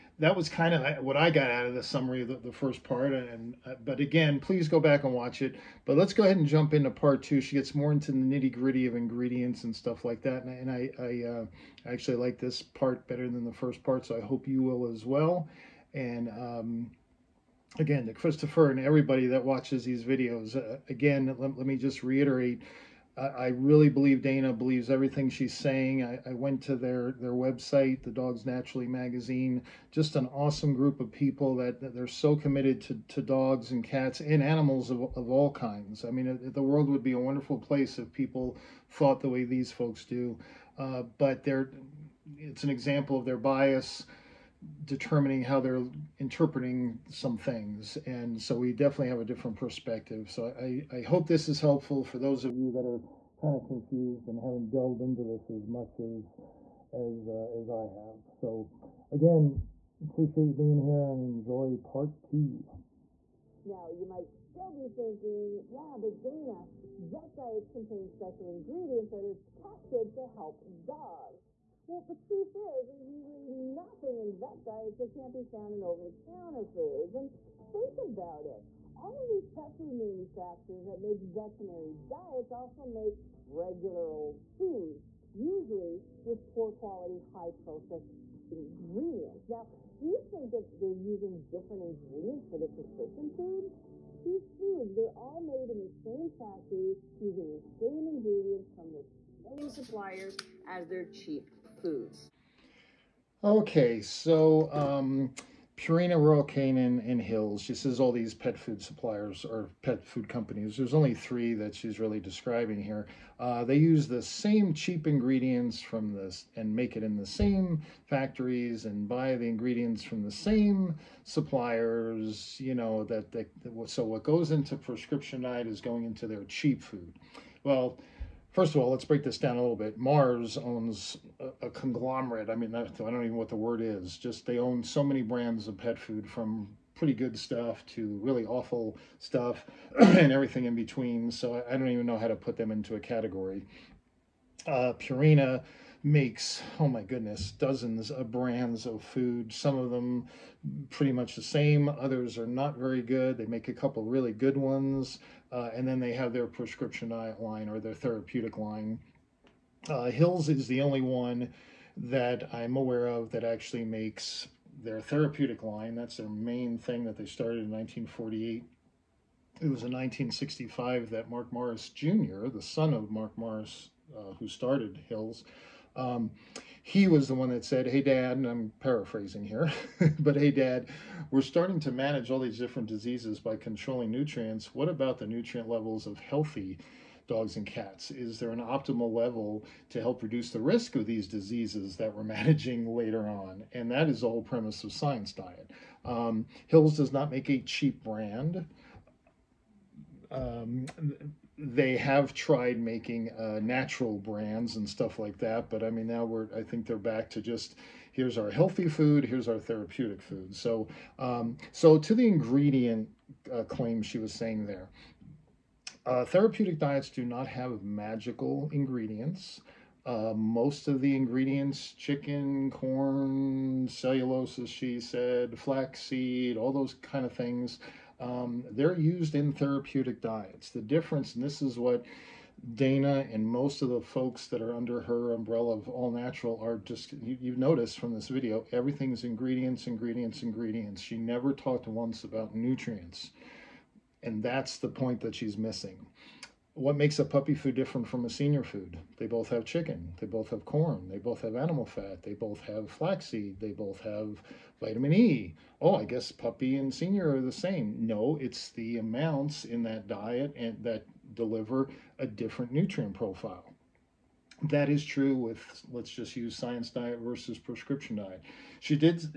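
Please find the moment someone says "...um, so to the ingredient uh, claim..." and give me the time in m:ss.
3:31.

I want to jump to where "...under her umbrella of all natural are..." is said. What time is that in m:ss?
3:54.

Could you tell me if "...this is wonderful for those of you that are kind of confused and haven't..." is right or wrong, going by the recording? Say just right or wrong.
wrong.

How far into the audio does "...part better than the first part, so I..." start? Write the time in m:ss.
0:12.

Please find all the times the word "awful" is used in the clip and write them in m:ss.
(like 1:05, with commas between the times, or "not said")
2:18.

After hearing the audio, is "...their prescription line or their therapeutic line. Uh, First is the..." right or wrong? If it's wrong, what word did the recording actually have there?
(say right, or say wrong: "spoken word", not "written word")
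wrong: "Hills", not "First".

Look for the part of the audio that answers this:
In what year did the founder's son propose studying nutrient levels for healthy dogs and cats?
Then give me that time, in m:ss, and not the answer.
2:49.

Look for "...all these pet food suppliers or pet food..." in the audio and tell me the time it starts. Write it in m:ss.
1:48.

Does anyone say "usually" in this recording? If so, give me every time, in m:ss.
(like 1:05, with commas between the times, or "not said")
1:13, 1:25.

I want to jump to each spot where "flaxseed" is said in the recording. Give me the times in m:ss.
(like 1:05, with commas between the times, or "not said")
3:45, 4:12.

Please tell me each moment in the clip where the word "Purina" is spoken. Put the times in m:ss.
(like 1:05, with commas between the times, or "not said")
1:45, 2:25.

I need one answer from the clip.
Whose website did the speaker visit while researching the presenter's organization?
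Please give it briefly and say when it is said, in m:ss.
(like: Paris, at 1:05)
Dogs Naturally magazine, at 0:28.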